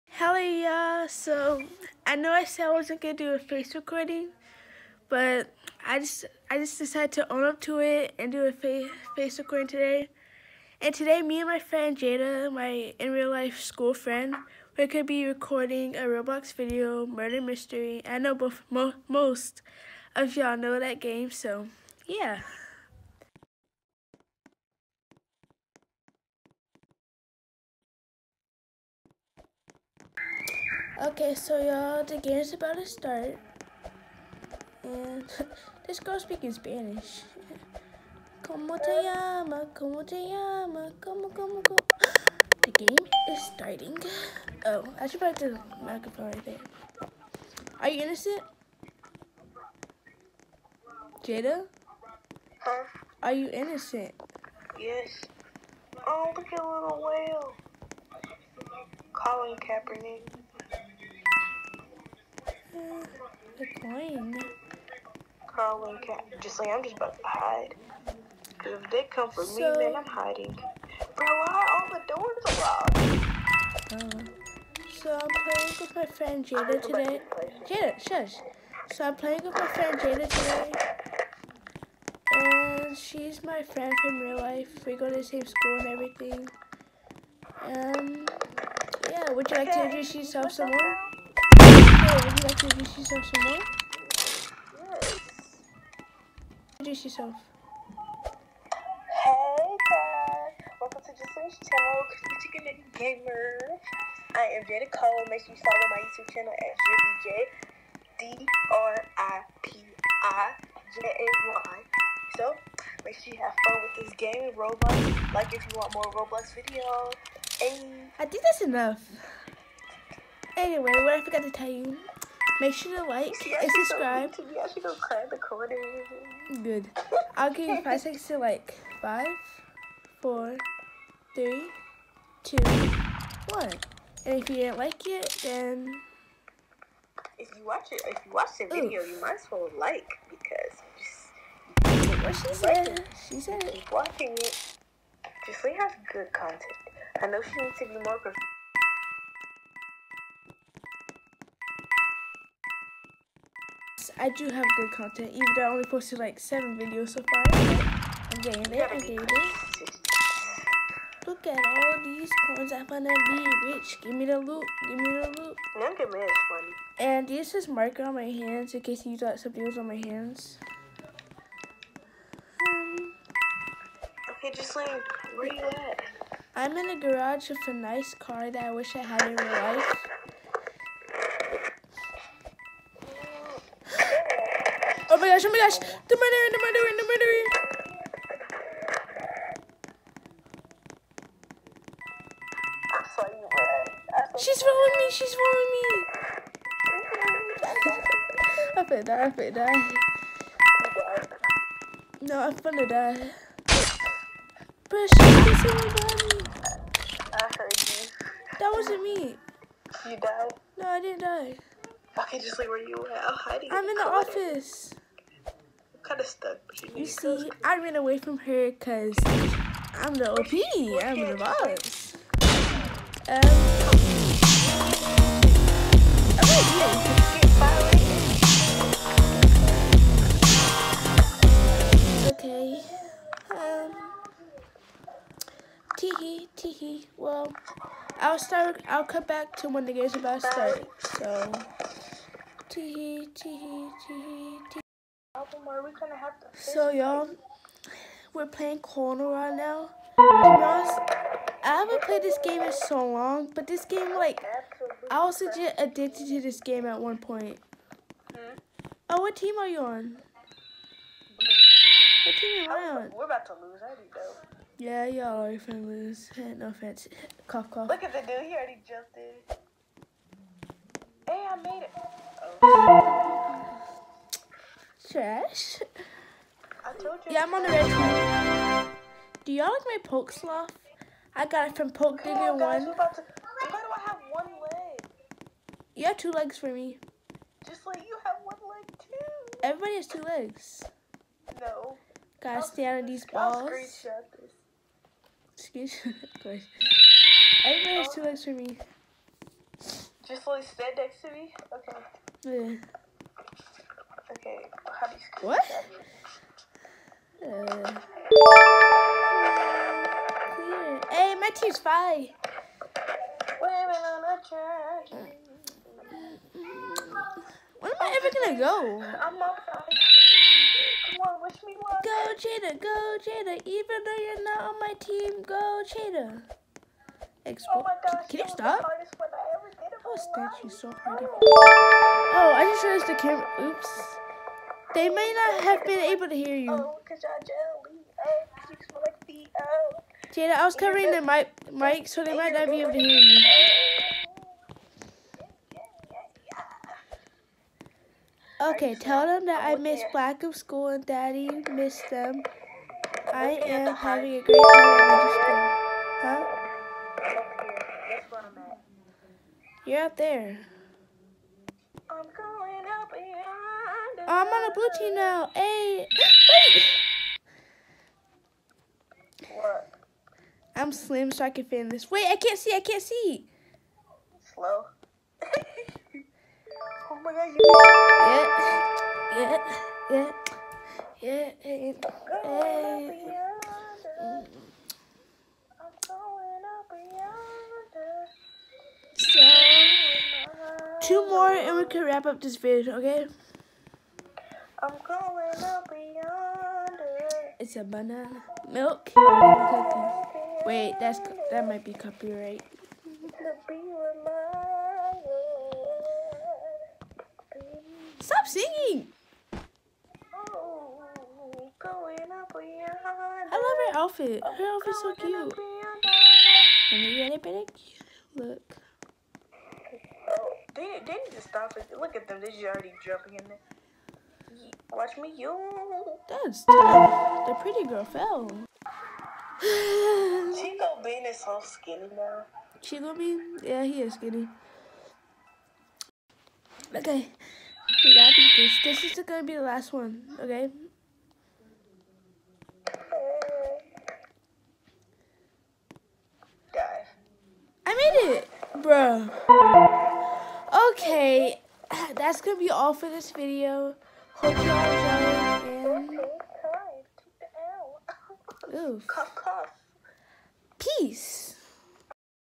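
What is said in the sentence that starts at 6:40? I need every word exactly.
Wait, that's that might be copyright.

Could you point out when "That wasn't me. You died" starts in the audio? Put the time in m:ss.
3:28.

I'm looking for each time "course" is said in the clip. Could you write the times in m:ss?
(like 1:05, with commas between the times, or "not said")
4:56.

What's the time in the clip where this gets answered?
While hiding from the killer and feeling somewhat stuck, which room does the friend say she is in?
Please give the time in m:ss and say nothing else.
3:34.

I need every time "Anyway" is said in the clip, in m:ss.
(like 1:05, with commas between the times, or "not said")
2:00.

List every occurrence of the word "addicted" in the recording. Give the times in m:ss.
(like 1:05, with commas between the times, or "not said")
4:15.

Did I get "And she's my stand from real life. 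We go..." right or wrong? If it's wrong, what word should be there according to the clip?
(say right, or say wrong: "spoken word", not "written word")
wrong: "friend", not "stand".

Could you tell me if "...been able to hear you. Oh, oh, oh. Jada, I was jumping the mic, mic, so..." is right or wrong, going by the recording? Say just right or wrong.
wrong.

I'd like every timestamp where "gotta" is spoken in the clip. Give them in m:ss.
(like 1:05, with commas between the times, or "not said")
4:52, 7:18.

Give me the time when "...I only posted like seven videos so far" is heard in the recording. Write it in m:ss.
2:35.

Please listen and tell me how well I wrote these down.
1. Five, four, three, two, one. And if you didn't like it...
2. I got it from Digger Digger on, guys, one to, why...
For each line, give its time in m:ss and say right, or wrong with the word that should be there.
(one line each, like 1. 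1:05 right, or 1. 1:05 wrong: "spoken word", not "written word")
1. 2:09 right
2. 4:41 wrong: "Poke", not "Digger".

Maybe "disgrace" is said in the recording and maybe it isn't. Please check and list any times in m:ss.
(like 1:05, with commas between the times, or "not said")
not said.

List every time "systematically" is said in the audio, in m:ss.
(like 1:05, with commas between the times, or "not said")
not said.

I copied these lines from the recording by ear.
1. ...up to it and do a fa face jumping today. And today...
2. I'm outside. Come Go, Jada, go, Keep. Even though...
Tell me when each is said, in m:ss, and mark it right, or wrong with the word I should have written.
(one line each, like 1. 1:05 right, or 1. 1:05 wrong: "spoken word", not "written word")
1. 0:07 wrong: "recording", not "jumping"
2. 5:19 wrong: "Jada", not "Keep".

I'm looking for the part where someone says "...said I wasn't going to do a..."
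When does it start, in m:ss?
0:02.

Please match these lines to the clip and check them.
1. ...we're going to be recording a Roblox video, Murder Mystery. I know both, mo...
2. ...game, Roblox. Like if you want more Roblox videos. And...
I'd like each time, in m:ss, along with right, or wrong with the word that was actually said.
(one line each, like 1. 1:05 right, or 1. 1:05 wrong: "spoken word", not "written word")
1. 0:14 right
2. 1:54 right.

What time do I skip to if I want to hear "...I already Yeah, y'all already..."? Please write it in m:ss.
4:23.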